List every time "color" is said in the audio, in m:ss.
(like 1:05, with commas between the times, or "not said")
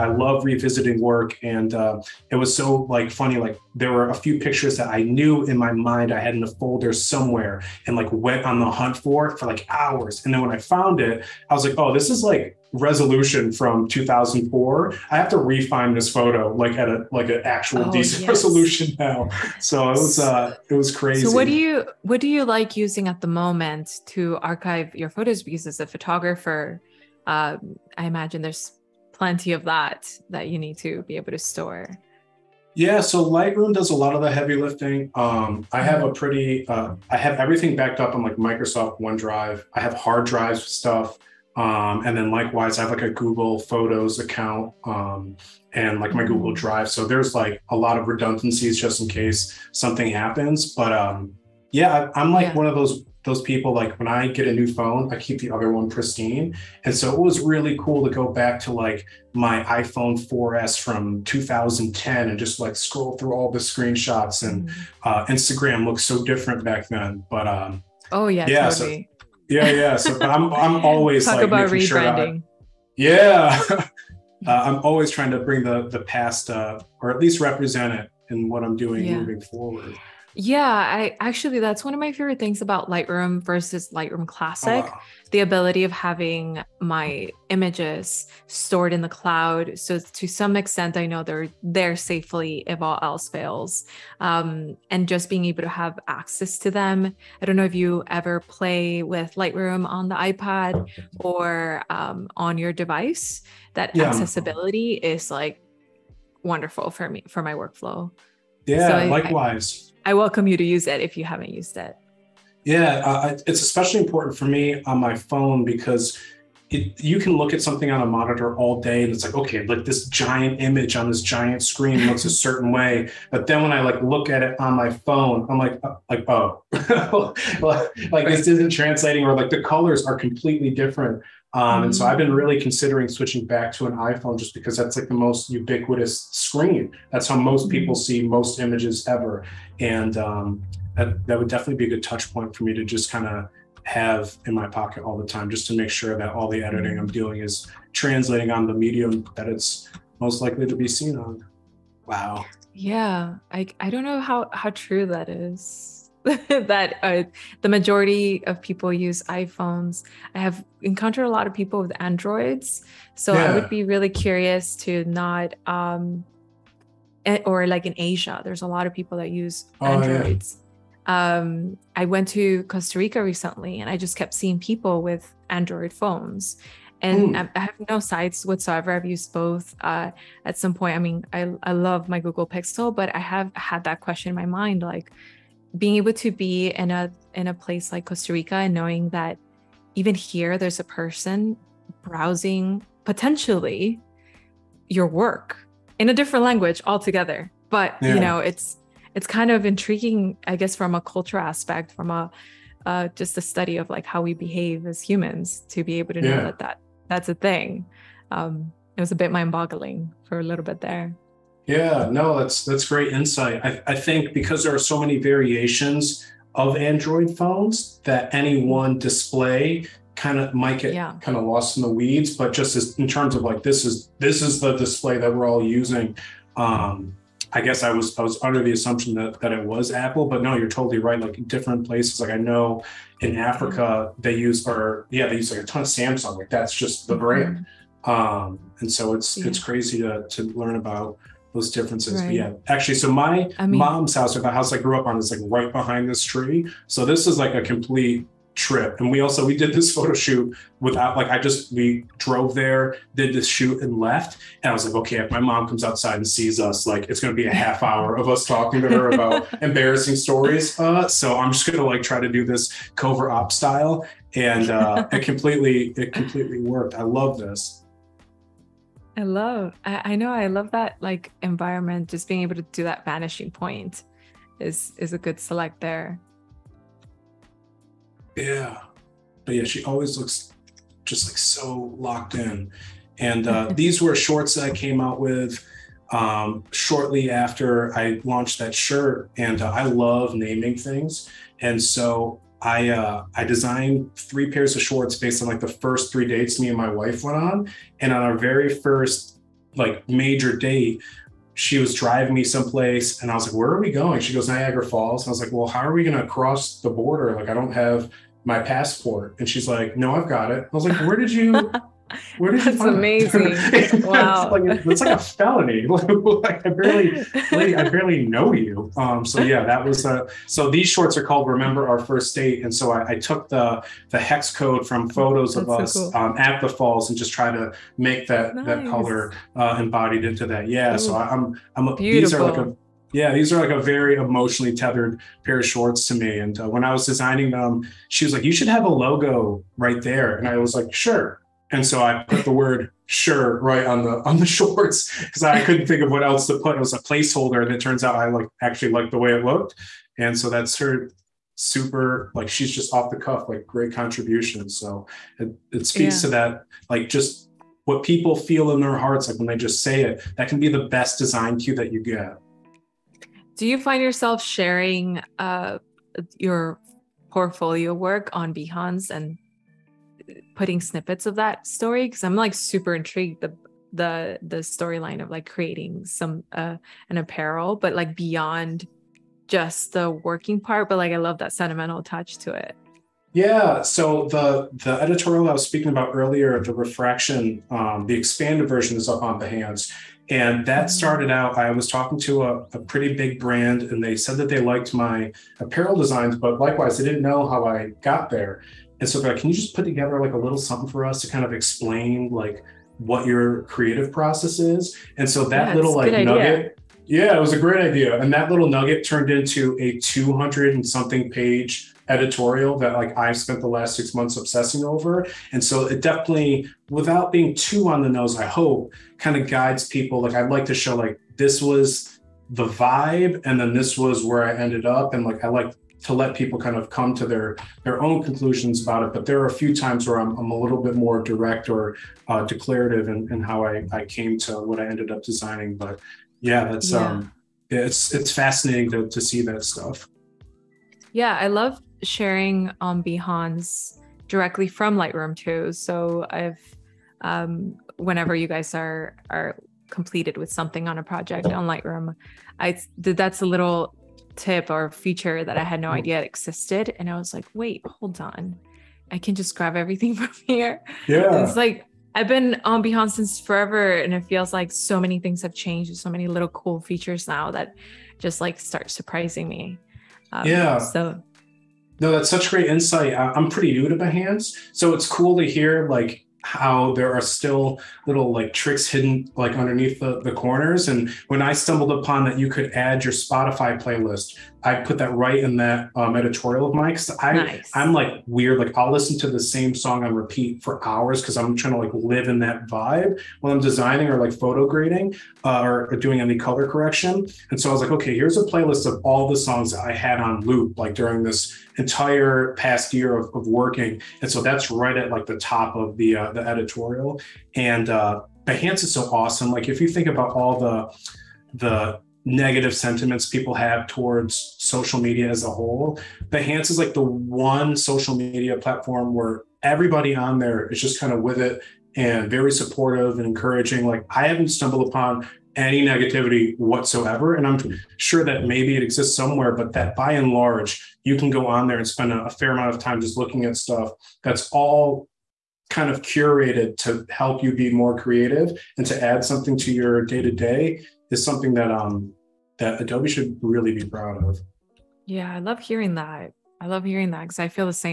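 2:09, 5:28, 8:16.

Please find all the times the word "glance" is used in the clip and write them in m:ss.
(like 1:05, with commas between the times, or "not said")
not said.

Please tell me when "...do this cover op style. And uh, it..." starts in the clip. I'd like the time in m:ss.
4:22.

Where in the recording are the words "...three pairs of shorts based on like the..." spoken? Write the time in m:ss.
4:54.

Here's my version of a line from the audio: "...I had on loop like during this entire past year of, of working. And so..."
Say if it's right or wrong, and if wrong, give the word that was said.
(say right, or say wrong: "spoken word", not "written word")
right.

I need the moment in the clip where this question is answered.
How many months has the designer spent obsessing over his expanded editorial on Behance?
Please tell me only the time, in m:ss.
6:53.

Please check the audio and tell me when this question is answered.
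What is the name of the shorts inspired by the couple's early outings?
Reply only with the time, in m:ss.
5:21.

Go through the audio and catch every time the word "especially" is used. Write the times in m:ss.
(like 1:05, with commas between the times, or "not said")
1:53.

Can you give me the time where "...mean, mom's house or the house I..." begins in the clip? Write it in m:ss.
4:03.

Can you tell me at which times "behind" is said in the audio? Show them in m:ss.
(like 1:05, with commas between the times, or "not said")
4:05.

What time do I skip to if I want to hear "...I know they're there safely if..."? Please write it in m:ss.
1:30.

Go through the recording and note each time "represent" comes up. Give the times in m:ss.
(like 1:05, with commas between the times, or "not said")
1:17.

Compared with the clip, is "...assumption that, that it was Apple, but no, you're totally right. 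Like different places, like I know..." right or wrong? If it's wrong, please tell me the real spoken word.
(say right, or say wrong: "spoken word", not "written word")
right.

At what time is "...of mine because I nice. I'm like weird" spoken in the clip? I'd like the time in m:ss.
8:06.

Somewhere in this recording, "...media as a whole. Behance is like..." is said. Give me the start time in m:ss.
8:35.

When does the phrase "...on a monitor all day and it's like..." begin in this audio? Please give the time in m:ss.
1:57.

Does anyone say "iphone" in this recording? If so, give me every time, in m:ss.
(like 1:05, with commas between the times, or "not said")
0:59, 2:13, 2:39.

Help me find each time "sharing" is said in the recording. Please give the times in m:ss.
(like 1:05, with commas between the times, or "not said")
6:04, 7:22.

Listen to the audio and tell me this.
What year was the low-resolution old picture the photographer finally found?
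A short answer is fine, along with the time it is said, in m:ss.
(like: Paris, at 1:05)
2004, at 0:13.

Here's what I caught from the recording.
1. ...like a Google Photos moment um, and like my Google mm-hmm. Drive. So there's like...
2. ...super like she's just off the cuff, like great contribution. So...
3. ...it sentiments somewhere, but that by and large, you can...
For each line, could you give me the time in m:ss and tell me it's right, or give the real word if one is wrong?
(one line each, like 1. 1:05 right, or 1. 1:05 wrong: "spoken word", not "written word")
1. 0:42 wrong: "account", not "moment"
2. 5:51 right
3. 8:48 wrong: "exists", not "sentiments".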